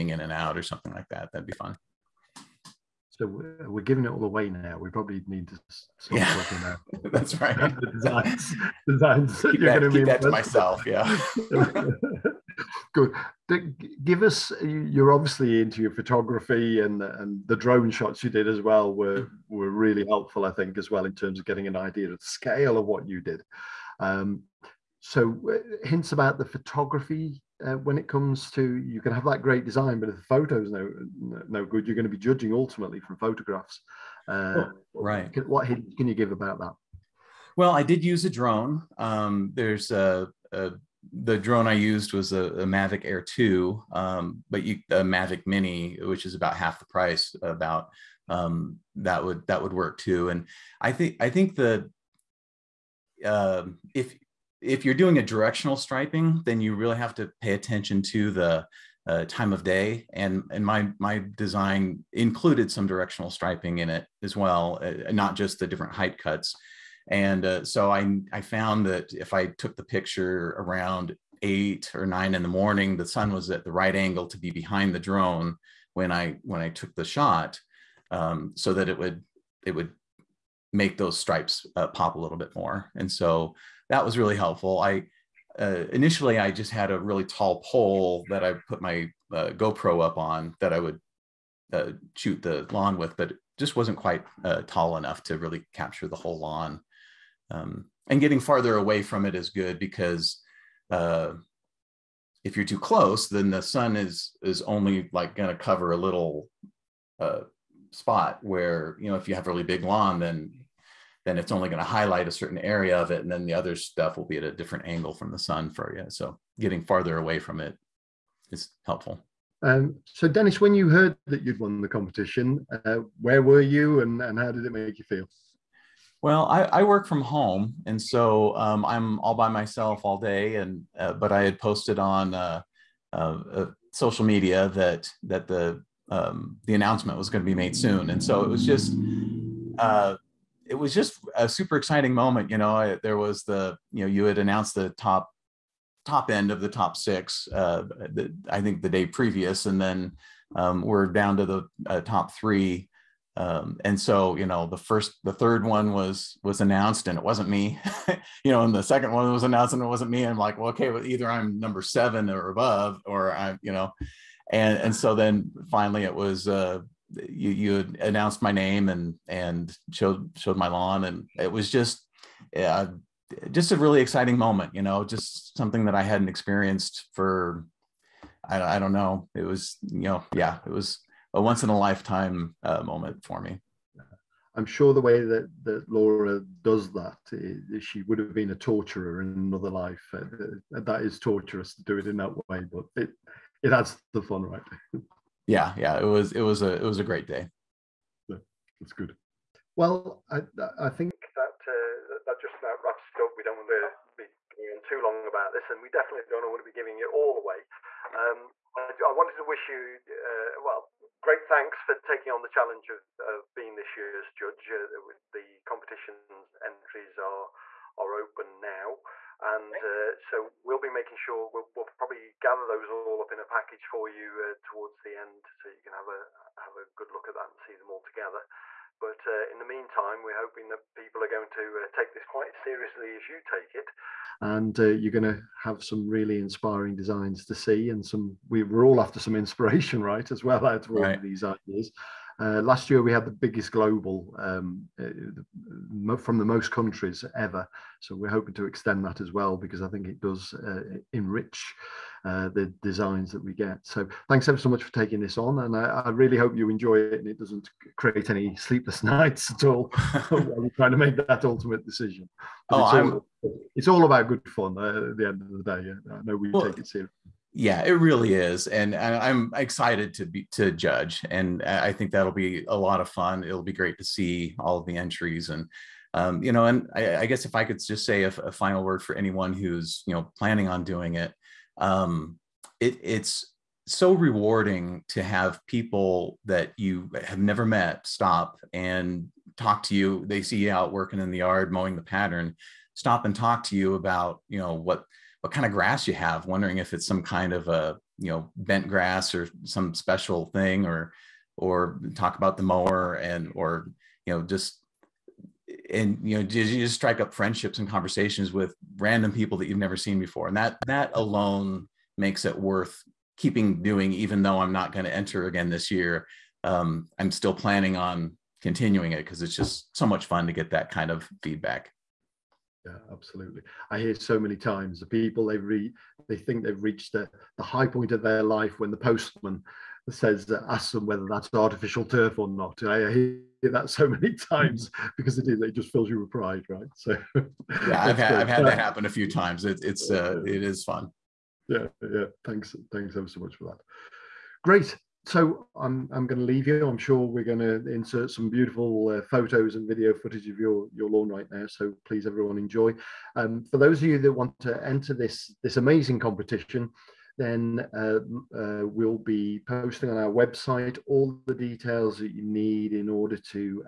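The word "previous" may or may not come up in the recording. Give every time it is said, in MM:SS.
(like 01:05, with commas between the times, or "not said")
02:29.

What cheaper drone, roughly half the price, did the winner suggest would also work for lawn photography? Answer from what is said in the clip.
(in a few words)
Mavic Mini.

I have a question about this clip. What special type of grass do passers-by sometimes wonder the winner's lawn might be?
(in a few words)
bent grass.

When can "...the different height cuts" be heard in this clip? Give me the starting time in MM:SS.
01:05.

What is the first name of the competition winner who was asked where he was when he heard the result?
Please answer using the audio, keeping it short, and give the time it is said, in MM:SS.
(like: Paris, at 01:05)
Dennis, at 02:00.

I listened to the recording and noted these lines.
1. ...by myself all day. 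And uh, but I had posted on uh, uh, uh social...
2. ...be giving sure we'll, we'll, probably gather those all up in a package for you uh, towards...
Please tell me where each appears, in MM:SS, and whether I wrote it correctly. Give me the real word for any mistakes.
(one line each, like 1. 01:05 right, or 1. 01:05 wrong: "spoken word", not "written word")
1. 02:09 right
2. 03:40 wrong: "making", not "giving".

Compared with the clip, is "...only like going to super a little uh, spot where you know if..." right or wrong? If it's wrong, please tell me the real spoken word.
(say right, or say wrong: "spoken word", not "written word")
wrong: "cover", not "super".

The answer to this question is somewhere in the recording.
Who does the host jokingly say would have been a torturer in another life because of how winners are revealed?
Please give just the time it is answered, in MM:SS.
03:05.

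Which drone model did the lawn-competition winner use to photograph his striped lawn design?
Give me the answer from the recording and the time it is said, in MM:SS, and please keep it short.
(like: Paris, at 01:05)
Mavic Air 2, at 00:42.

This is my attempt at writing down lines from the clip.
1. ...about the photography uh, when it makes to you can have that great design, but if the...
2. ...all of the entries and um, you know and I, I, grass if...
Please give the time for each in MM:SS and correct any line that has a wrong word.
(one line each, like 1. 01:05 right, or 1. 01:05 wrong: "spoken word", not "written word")
1. 00:26 wrong: "comes", not "makes"
2. 04:34 wrong: "guess", not "grass".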